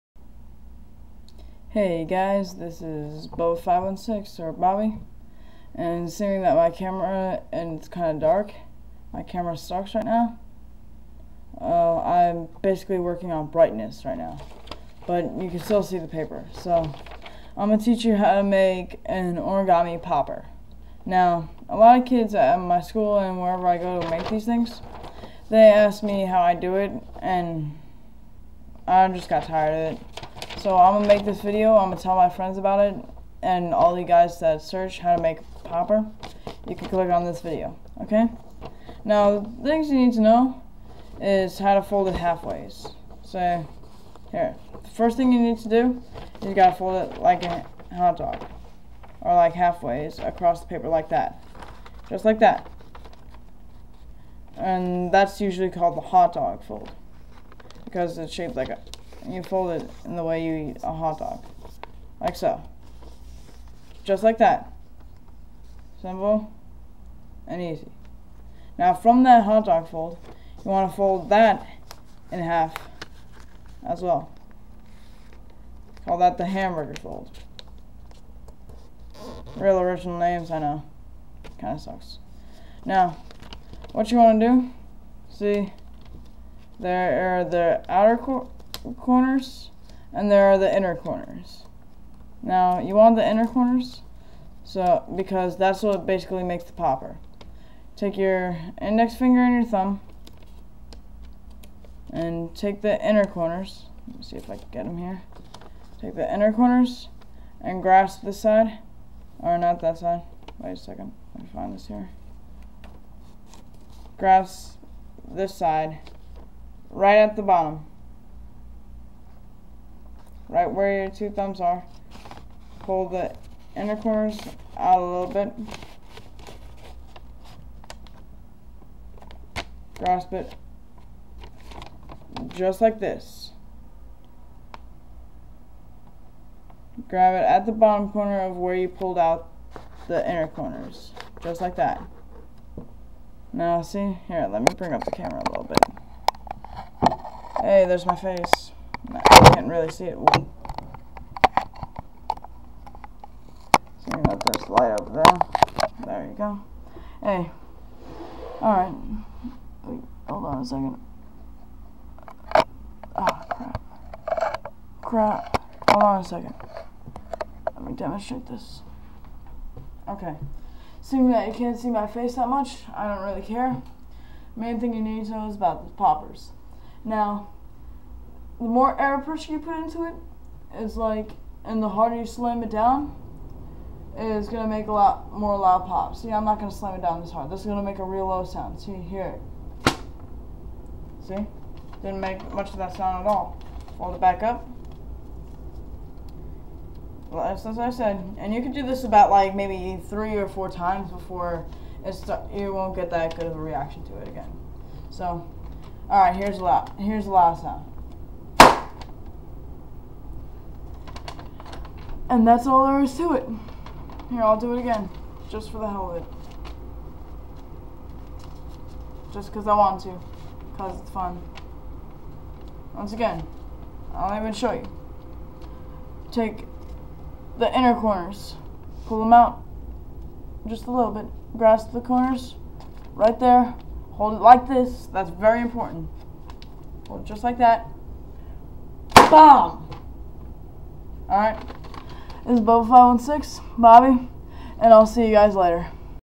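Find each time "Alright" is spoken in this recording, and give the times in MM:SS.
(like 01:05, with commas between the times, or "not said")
02:38, 04:01.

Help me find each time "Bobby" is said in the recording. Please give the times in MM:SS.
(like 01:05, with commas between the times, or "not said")
00:04, 04:03.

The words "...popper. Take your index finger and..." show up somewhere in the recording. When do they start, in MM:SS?
01:36.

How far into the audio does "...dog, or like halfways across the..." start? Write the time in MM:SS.
00:48.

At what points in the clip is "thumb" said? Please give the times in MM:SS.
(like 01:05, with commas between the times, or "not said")
01:39, 02:01.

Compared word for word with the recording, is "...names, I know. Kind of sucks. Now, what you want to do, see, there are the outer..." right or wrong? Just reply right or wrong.
right.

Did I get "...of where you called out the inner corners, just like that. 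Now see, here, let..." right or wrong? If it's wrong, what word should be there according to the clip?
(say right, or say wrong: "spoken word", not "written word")
wrong: "pulled", not "called".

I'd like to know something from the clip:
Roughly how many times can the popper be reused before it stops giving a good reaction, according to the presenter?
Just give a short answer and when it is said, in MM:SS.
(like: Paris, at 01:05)
3 or 4 times, at 03:20.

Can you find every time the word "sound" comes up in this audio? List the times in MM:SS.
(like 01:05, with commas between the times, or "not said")
03:08, 03:12, 03:27.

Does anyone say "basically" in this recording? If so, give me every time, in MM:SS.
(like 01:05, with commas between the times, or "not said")
00:12, 01:36.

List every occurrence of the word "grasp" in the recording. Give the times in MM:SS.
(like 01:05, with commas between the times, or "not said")
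01:47, 01:54, 02:09, 03:51.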